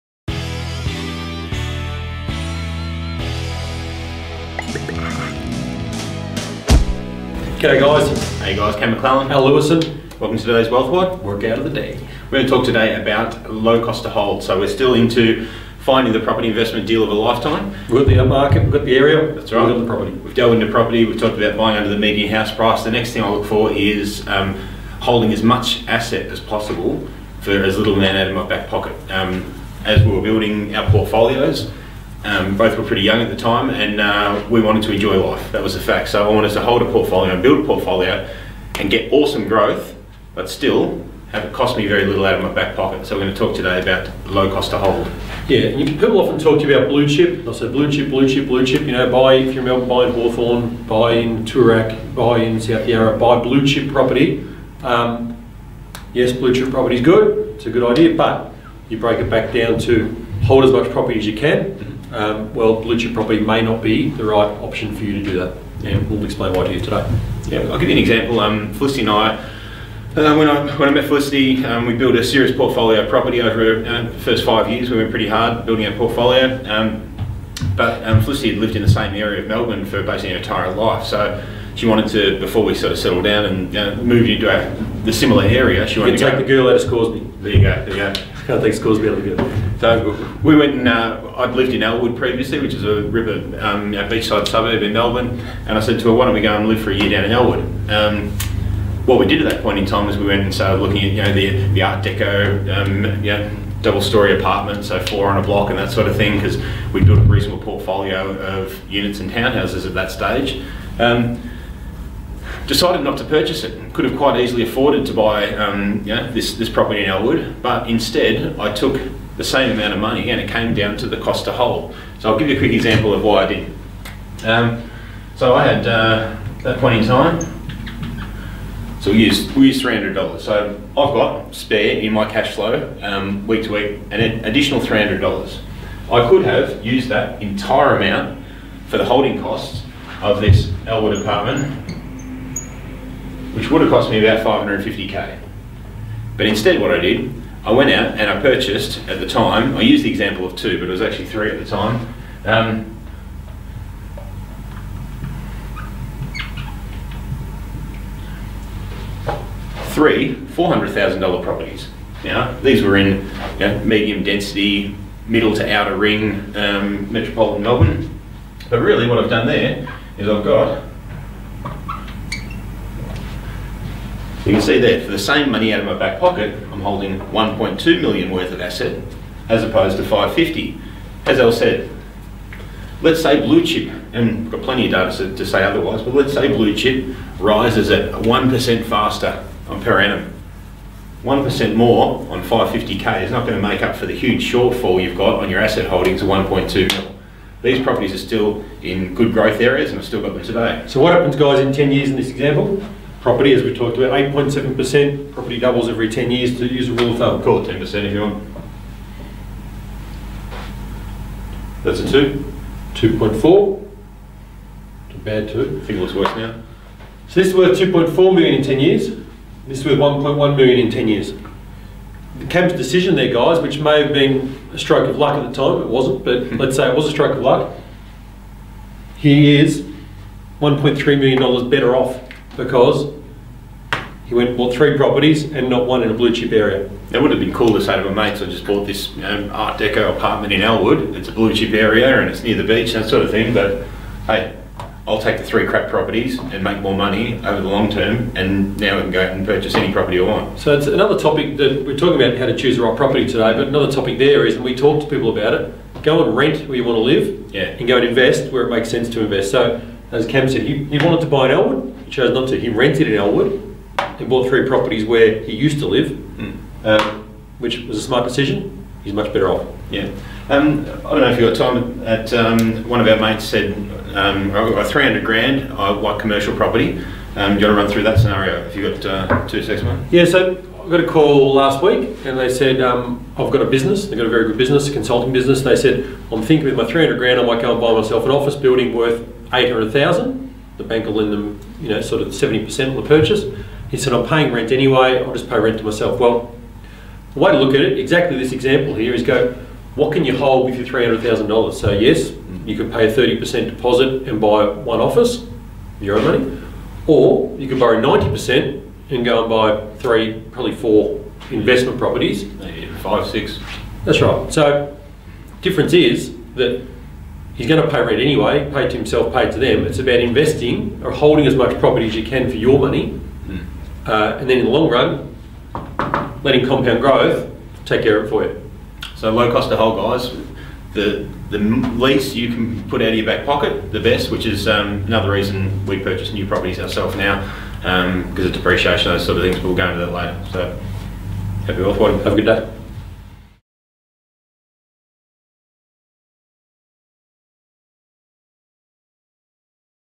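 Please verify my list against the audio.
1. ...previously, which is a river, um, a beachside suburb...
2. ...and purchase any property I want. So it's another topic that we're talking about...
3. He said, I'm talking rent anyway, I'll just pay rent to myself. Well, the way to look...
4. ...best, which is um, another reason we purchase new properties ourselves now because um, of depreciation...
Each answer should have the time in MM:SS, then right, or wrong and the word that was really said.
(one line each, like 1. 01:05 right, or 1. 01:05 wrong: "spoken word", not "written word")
1. 01:32 right
2. 04:09 right
3. 04:53 wrong: "paying", not "talking"
4. 05:33 right.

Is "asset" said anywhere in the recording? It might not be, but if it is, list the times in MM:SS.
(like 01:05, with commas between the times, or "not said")
00:25, 02:58, 03:15.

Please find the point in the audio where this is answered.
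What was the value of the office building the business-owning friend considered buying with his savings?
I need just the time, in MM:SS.
04:49.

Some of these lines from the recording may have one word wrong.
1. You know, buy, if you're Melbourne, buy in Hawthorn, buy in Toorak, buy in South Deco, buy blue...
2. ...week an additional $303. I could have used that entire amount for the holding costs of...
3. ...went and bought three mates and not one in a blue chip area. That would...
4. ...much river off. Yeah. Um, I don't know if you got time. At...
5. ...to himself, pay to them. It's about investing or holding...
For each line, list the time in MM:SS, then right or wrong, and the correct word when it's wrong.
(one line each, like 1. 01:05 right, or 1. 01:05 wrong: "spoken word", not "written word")
1. 00:48 wrong: "Yarra", not "Deco"
2. 02:13 wrong: "300", not "303"
3. 03:54 wrong: "properties", not "mates"
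4. 04:29 wrong: "better", not "river"
5. 05:18 right.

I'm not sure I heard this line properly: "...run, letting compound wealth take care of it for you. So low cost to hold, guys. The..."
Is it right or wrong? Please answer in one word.
wrong.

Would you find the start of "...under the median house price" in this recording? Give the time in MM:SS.
00:21.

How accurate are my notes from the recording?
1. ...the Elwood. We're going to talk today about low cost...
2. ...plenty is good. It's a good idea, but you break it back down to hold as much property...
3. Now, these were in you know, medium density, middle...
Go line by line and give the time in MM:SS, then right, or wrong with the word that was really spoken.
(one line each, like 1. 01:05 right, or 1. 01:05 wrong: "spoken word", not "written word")
1. 00:11 wrong: "Day", not "Elwood"
2. 00:56 wrong: "property", not "plenty"
3. 02:42 right.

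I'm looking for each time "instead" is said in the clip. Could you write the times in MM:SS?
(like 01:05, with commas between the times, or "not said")
01:57, 02:26.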